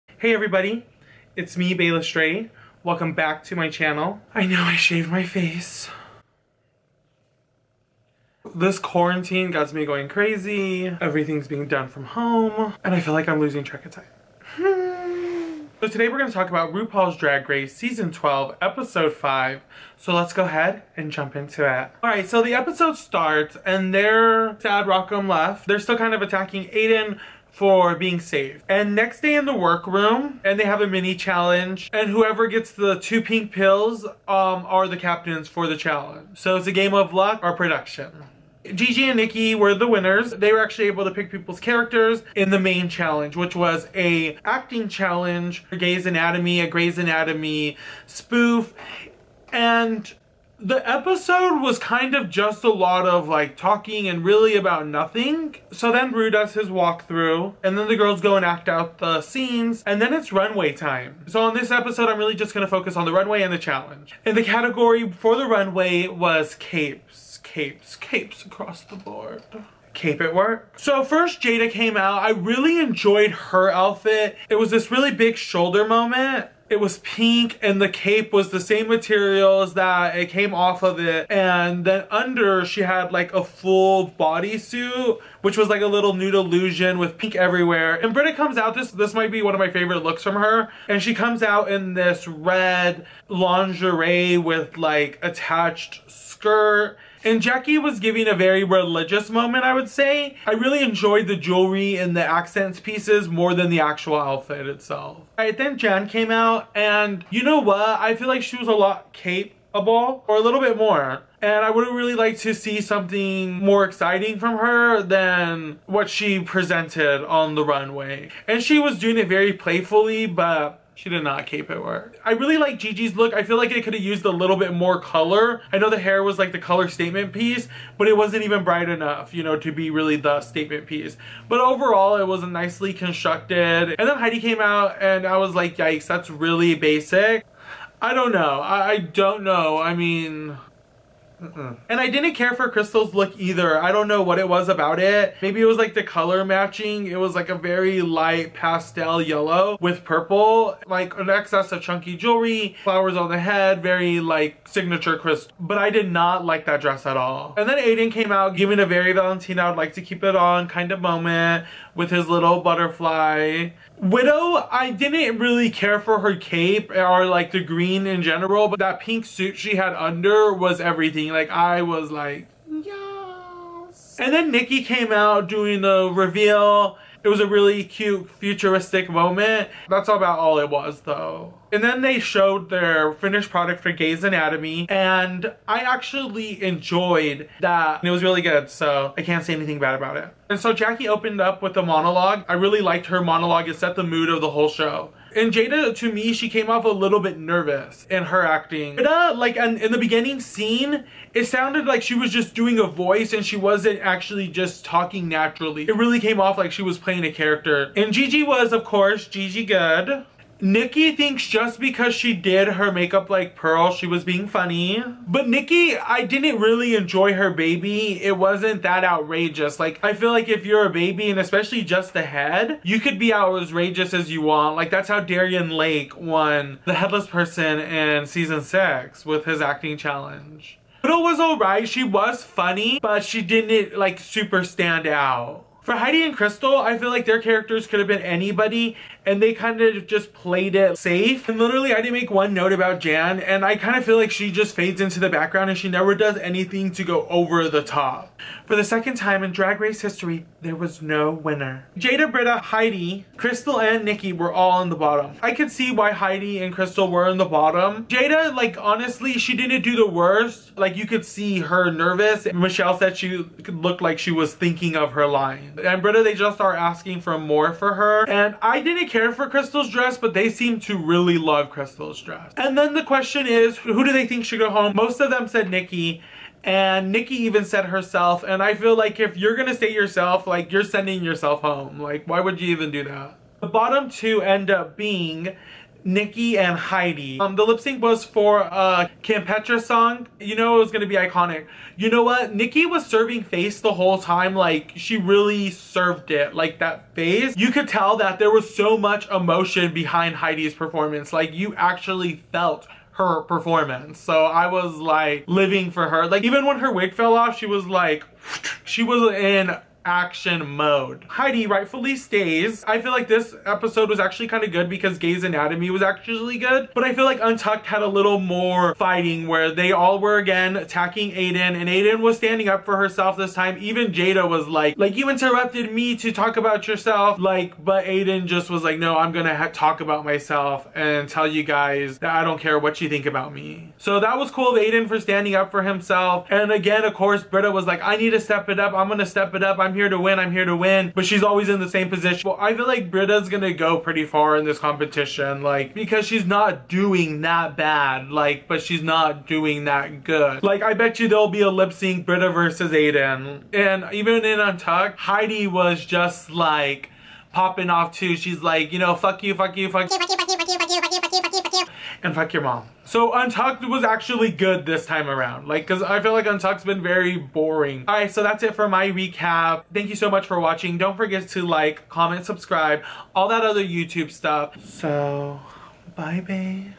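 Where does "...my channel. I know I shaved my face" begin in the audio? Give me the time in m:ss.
0:03.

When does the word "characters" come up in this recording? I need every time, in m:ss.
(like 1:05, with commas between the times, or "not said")
0:41, 3:27, 3:57.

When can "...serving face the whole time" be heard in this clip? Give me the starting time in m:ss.
4:53.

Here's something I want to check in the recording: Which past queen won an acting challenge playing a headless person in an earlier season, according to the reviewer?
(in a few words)
Darienne Lake.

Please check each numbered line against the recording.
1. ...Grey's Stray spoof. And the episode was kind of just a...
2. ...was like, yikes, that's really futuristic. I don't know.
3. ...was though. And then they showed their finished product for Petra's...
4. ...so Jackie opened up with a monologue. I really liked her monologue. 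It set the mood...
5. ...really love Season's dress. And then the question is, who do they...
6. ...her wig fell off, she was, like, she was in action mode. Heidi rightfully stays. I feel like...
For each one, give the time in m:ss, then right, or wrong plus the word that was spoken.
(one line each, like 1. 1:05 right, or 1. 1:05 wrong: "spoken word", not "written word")
1. 0:46 wrong: "Anatomy", not "Stray"
2. 2:15 wrong: "basic", not "futuristic"
3. 3:00 wrong: "Gay", not "Petra"
4. 3:10 right
5. 4:30 wrong: "Crystal", not "Season"
6. 5:06 right.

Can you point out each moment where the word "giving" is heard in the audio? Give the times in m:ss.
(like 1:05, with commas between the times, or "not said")
1:37, 2:38.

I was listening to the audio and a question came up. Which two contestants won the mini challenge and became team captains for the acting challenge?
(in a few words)
Gigi and Nicky.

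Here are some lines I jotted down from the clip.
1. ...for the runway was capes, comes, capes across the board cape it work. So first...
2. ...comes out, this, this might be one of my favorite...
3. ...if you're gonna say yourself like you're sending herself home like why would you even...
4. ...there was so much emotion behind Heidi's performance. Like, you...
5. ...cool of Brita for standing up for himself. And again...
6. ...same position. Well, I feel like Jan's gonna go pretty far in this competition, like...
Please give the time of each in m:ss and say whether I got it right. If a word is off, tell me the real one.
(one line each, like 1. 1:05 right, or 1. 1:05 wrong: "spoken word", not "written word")
1. 1:05 wrong: "capes", not "comes"
2. 1:28 right
3. 4:39 wrong: "yourself", not "herself"
4. 4:58 right
5. 5:34 wrong: "Aiden", not "Brita"
6. 5:41 wrong: "Brita", not "Jan".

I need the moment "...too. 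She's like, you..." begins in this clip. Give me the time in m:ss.
5:58.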